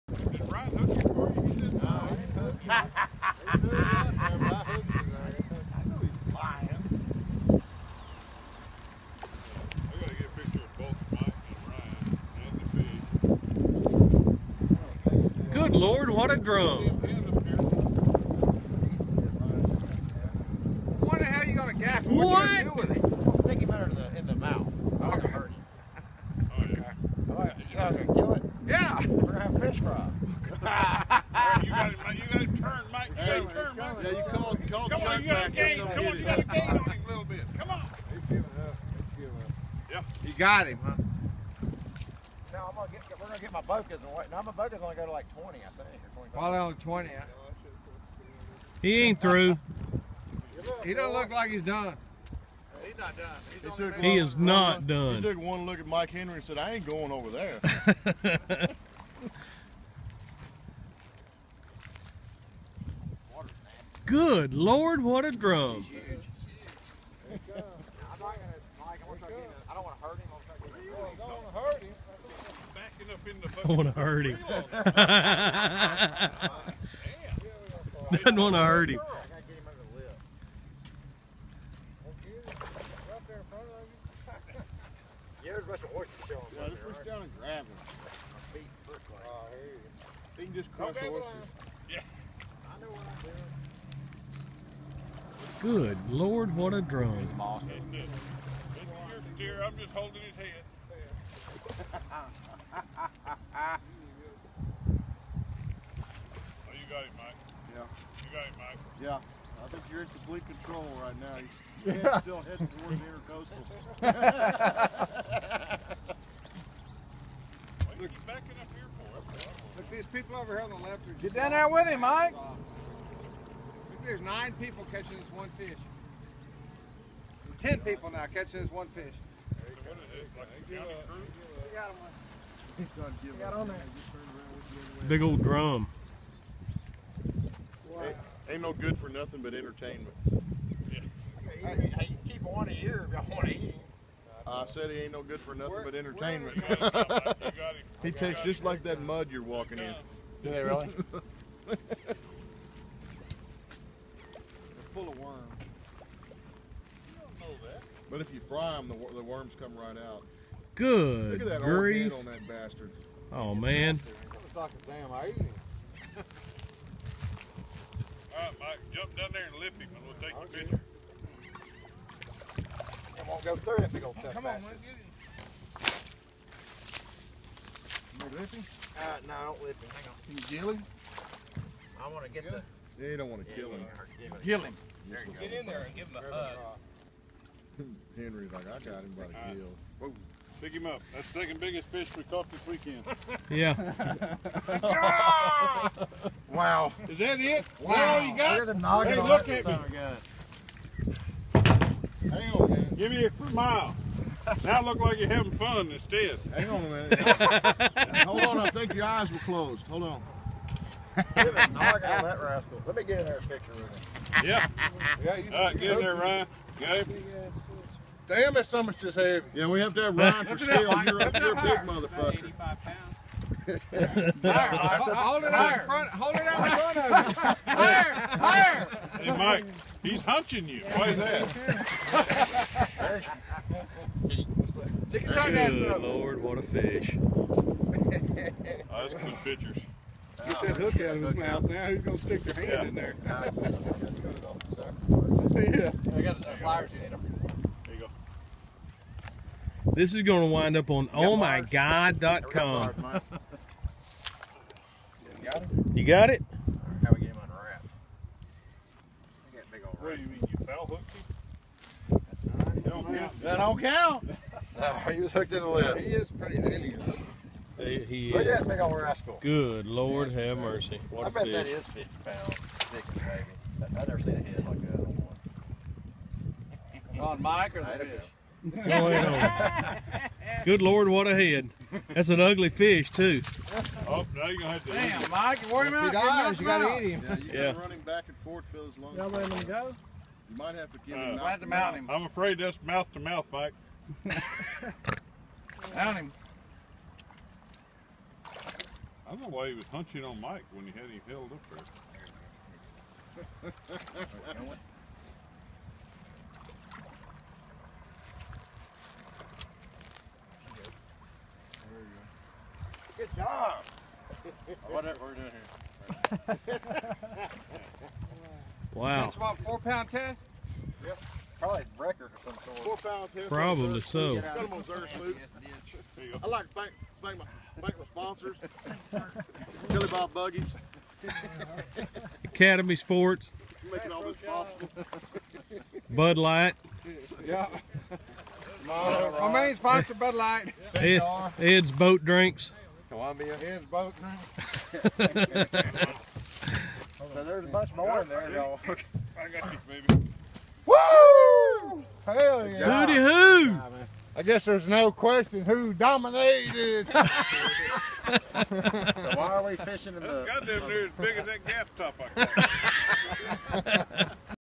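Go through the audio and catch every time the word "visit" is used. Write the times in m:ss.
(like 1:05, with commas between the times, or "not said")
not said.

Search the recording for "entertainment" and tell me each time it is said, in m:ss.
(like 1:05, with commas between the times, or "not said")
2:19, 2:25.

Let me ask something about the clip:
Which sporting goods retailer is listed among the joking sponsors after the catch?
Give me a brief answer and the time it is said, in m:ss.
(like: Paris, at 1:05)
Academy Sports, at 5:32.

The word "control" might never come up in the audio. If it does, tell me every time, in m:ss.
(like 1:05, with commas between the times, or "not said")
1:50.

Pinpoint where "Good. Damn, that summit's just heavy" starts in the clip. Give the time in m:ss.
3:36.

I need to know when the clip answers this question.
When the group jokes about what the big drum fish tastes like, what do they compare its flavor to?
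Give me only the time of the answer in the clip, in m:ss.
2:28.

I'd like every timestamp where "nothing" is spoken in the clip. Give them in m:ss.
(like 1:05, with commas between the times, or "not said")
2:19, 2:25.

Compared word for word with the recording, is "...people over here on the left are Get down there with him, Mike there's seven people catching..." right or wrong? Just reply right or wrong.
wrong.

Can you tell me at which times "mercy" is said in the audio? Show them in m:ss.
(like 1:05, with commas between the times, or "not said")
4:30.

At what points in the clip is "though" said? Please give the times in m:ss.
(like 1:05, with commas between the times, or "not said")
5:48.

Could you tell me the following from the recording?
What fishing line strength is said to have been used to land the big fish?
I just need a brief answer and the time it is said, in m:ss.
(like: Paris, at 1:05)
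4 pound test, at 5:19.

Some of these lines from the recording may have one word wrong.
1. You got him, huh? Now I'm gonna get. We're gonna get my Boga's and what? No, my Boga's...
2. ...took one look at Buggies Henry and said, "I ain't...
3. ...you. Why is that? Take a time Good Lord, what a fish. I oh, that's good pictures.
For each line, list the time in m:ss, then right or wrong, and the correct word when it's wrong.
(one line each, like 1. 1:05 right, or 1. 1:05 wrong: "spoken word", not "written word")
1. 0:40 right
2. 0:55 wrong: "Mike", not "Buggies"
3. 3:50 right.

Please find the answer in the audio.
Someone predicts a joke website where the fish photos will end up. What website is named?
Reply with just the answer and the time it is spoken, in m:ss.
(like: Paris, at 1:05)
ohmygod.com, at 4:11.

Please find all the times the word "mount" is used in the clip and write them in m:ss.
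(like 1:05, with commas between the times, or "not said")
4:51, 4:55.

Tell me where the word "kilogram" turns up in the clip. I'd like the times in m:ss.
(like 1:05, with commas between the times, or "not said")
not said.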